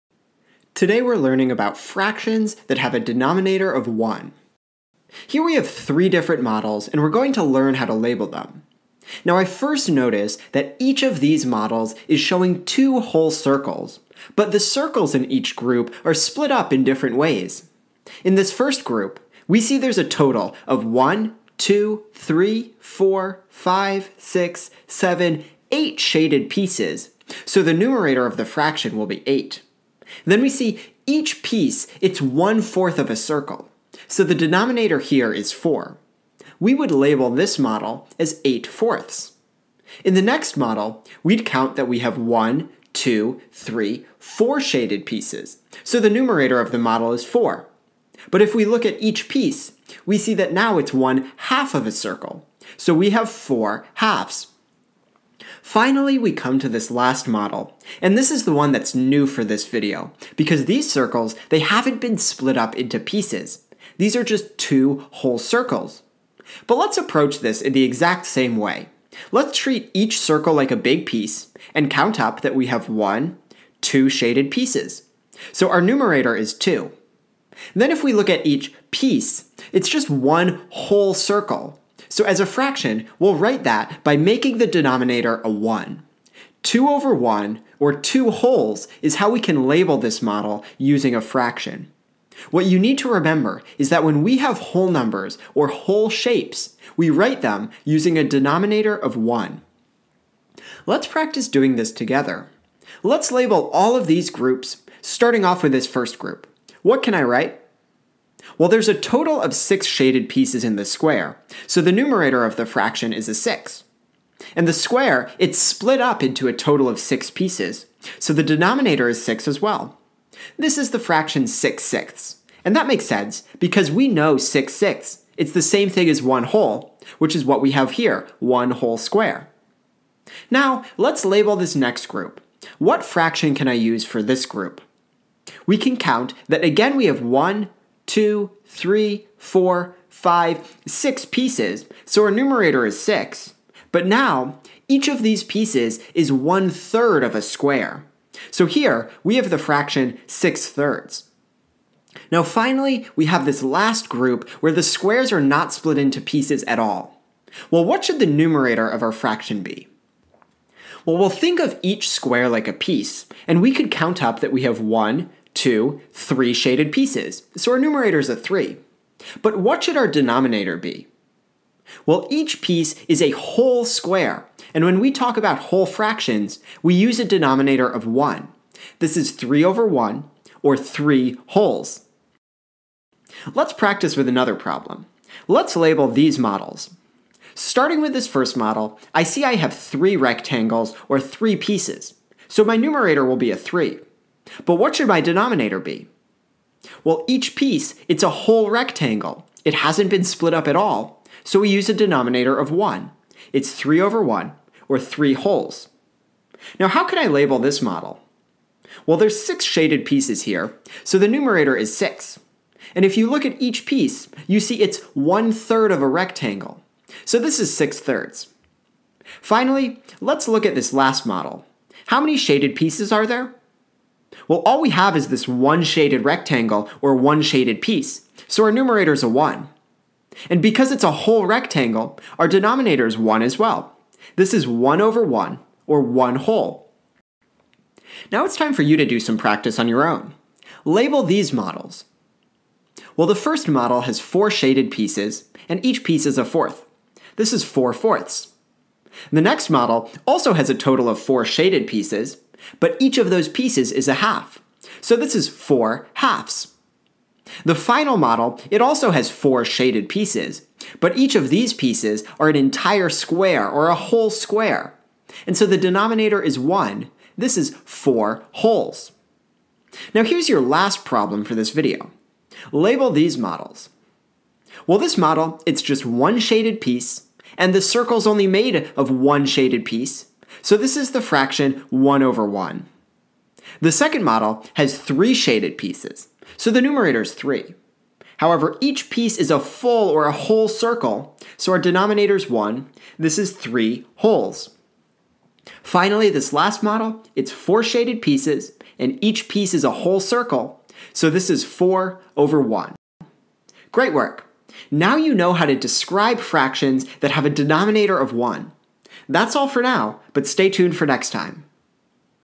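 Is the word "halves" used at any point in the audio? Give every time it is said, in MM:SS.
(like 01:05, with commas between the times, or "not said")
00:53, 04:16.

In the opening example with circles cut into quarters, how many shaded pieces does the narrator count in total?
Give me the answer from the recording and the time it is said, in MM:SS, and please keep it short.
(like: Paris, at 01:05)
8, at 00:27.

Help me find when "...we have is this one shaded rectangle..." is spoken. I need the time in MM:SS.
03:44.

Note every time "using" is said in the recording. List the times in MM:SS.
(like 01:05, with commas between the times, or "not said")
01:30, 01:37.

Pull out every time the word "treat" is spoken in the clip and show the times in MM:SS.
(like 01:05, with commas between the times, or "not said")
01:09.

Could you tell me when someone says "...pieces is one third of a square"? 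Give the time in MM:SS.
02:25.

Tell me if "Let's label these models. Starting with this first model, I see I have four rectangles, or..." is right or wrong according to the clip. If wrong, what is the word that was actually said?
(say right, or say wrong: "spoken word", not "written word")
wrong: "three", not "four".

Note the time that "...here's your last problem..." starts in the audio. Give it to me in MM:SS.
04:30.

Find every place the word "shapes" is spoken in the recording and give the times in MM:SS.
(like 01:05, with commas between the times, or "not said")
01:36.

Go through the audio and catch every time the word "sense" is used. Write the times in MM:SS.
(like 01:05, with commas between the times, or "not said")
02:03.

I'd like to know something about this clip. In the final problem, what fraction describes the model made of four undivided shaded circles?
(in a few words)
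4 over 1.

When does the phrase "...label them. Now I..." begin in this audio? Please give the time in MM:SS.
00:07.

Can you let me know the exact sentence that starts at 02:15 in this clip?
We can count that again we have 1, two, three, four, five, six pieces.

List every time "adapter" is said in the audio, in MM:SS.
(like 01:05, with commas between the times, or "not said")
not said.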